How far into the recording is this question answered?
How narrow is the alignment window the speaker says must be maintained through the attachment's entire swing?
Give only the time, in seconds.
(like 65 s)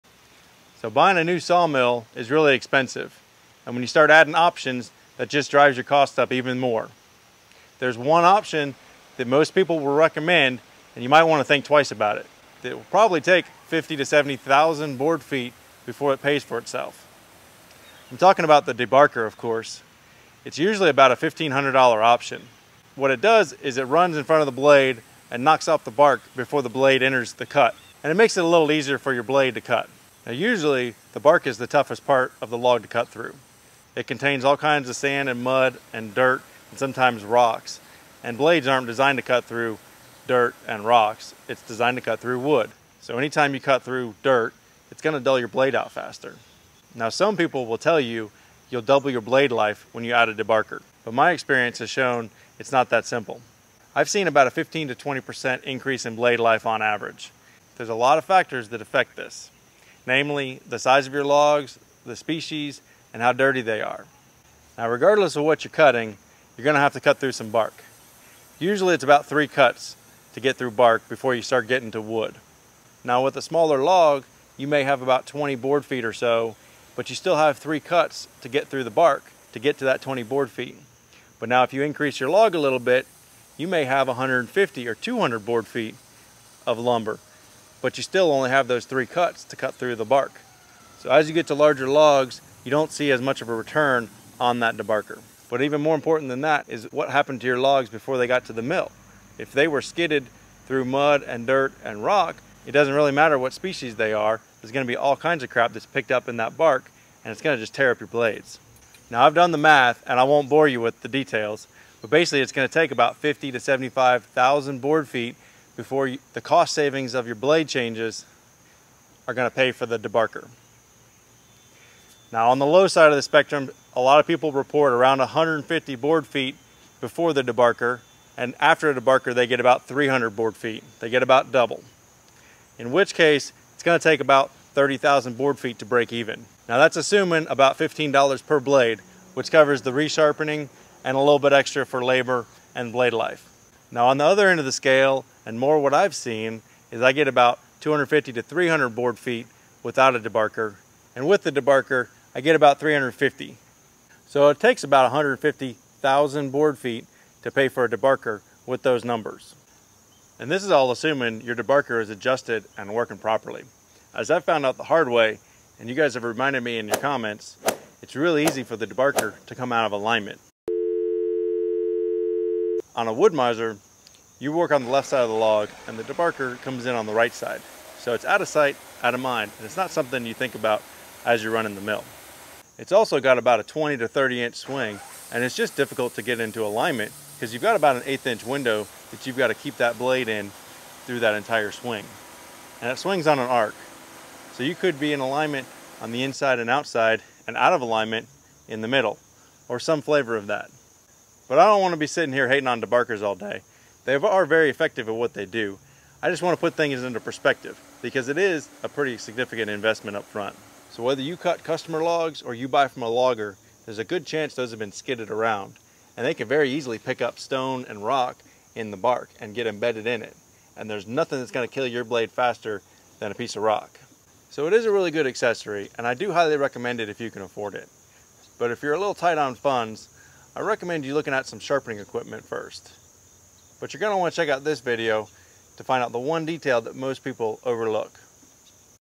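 187 s.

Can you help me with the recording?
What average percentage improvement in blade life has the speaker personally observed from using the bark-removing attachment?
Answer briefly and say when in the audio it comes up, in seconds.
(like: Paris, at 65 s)
15 to 20%, at 54 s.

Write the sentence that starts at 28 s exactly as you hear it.
And it makes it a little easier for your blade to cut.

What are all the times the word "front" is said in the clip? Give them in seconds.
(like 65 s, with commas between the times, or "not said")
24 s, 210 s.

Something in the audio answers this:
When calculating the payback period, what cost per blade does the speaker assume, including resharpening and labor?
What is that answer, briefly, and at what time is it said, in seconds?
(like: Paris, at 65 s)
$15, at 137 s.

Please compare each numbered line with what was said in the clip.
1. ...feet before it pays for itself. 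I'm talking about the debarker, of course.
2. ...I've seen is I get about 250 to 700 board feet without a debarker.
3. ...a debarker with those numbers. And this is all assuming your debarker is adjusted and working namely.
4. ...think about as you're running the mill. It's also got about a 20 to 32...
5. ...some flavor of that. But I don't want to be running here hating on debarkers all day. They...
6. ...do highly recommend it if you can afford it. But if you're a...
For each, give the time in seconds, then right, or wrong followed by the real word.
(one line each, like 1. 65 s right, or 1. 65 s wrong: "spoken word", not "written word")
1. 15 s right
2. 145 s wrong: "300", not "700"
3. 157 s wrong: "properly", not "namely"
4. 180 s wrong: "30", not "32"
5. 199 s wrong: "sitting", not "running"
6. 226 s right.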